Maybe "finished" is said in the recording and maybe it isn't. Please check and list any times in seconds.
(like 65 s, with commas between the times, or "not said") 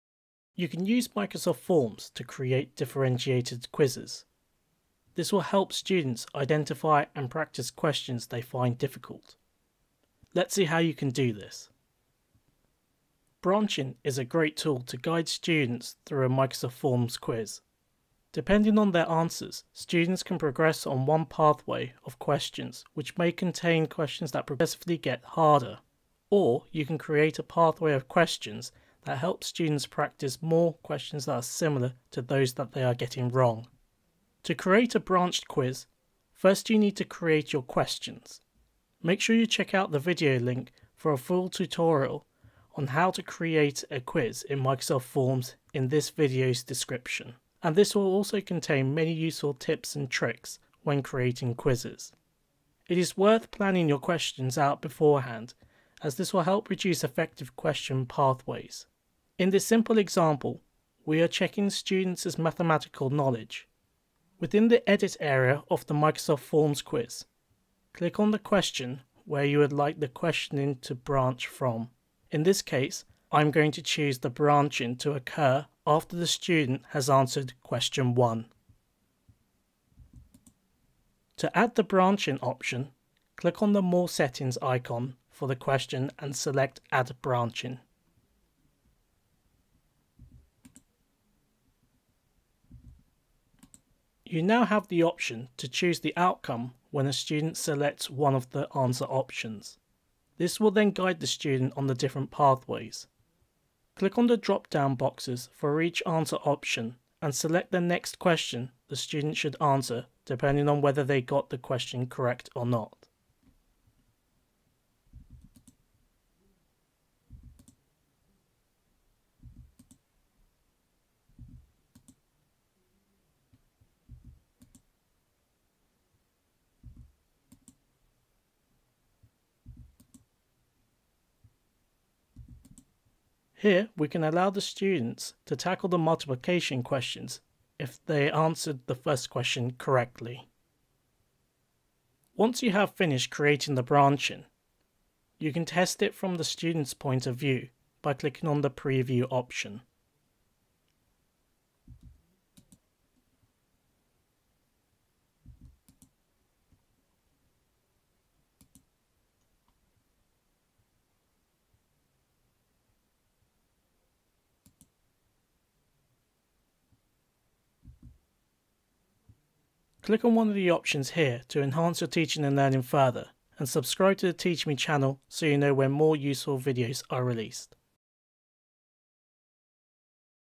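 142 s.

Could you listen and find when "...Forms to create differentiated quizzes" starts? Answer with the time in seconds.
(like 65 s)
1 s.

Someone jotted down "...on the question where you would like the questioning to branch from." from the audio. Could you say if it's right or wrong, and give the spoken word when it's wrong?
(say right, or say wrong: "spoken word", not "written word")
right.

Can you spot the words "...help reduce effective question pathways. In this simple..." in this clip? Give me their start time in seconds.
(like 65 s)
56 s.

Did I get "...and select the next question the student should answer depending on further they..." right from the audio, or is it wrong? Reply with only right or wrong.
wrong.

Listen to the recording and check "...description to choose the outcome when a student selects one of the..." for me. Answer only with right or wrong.
wrong.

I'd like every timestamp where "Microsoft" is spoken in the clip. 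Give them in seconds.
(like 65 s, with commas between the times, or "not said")
1 s, 16 s, 44 s, 65 s.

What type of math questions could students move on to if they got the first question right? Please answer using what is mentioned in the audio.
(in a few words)
Multiplication.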